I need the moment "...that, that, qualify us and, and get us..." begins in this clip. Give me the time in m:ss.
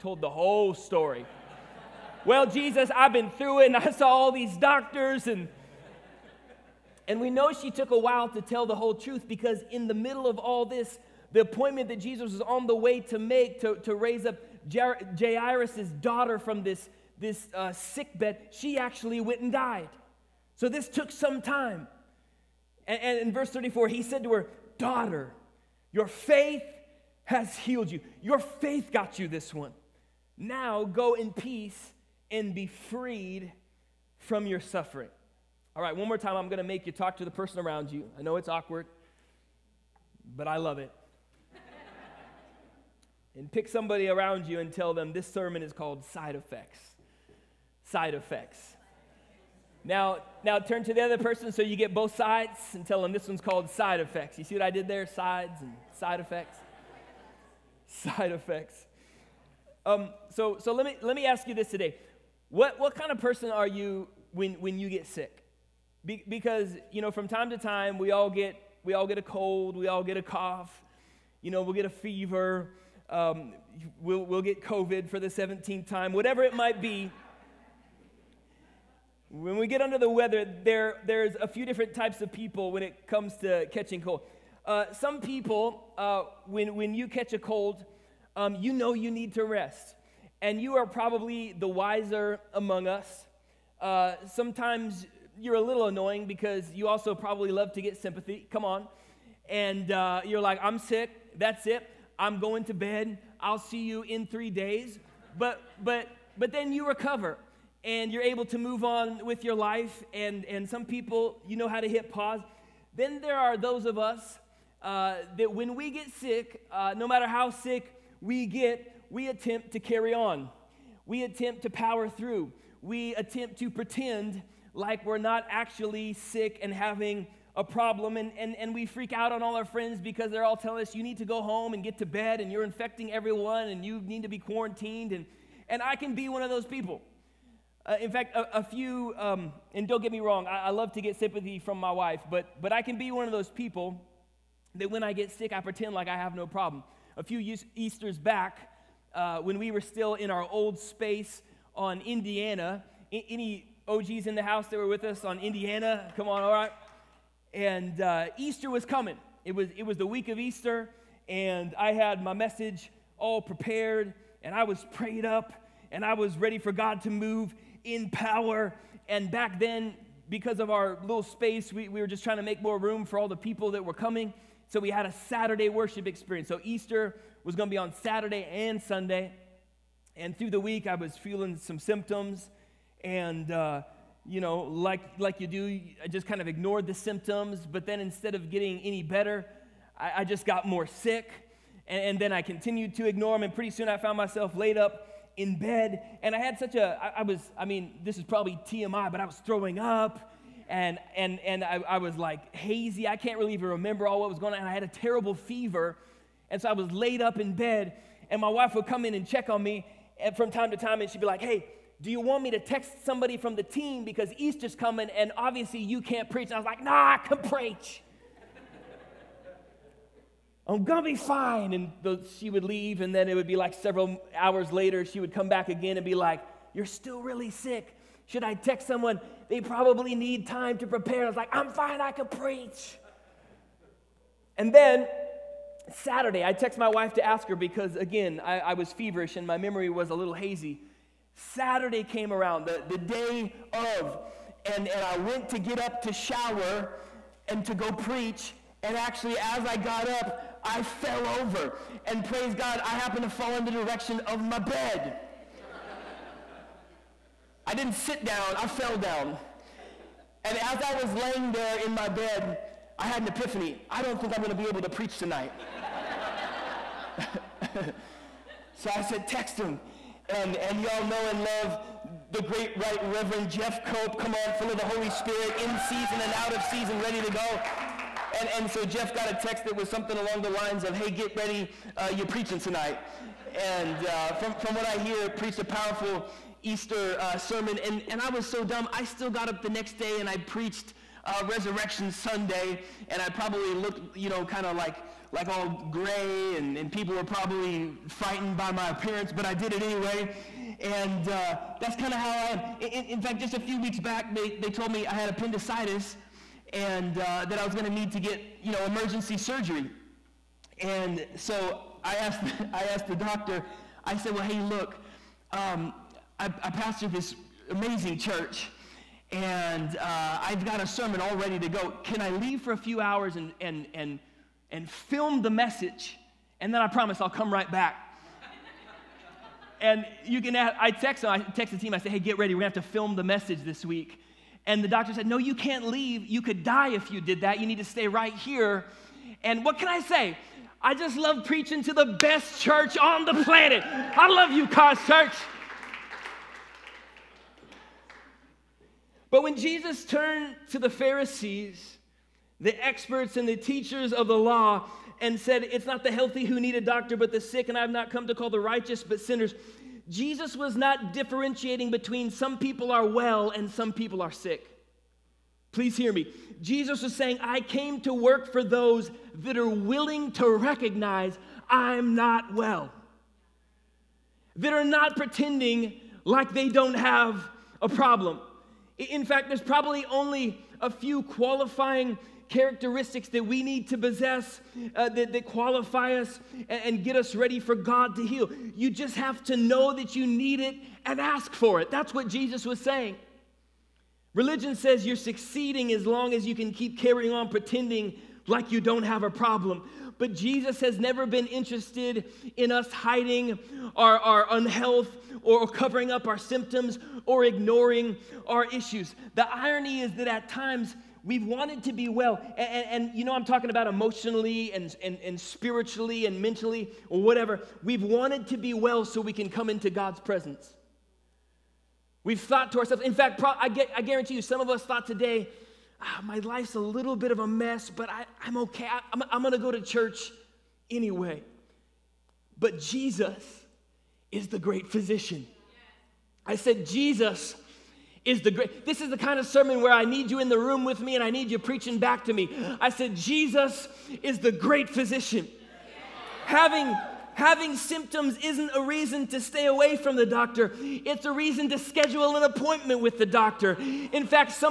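6:25.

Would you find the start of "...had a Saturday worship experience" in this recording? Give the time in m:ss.
2:54.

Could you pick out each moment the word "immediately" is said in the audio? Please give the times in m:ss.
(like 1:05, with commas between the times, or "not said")
not said.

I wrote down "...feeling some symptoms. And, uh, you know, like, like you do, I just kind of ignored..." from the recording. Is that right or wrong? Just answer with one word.
right.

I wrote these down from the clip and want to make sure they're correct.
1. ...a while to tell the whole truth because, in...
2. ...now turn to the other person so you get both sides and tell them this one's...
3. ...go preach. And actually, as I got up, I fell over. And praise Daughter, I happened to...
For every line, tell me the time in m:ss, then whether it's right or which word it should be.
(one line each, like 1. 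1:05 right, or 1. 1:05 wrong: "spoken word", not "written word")
1. 0:07 right
2. 0:50 right
3. 4:07 wrong: "God", not "Daughter".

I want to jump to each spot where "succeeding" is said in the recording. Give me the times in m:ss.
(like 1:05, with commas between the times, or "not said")
6:35.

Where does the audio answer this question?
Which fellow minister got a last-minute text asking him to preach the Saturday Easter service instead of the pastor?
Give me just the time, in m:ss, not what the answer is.
4:33.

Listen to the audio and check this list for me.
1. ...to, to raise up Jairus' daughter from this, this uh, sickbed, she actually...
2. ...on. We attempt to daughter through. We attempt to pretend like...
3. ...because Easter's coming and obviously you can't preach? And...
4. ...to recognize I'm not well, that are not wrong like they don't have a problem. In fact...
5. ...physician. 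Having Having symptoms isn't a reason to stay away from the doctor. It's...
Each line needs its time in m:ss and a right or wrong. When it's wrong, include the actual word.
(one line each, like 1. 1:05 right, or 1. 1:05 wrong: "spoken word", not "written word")
1. 0:13 right
2. 2:00 wrong: "power", not "daughter"
3. 3:34 right
4. 6:10 wrong: "pretending", not "wrong"
5. 7:24 right.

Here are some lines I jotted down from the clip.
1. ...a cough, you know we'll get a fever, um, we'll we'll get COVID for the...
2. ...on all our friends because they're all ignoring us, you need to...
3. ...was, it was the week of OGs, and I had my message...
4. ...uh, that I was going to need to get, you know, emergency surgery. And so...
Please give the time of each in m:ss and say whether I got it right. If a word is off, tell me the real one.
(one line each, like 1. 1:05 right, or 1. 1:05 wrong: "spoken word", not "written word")
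1. 1:10 right
2. 2:09 wrong: "telling", not "ignoring"
3. 2:39 wrong: "Easter", not "OGs"
4. 5:07 right.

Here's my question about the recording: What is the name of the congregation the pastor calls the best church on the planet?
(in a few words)
Cause Church.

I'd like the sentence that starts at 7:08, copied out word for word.
I, I'm, I'm going to go to church anyway.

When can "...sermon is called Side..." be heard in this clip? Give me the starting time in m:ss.
0:45.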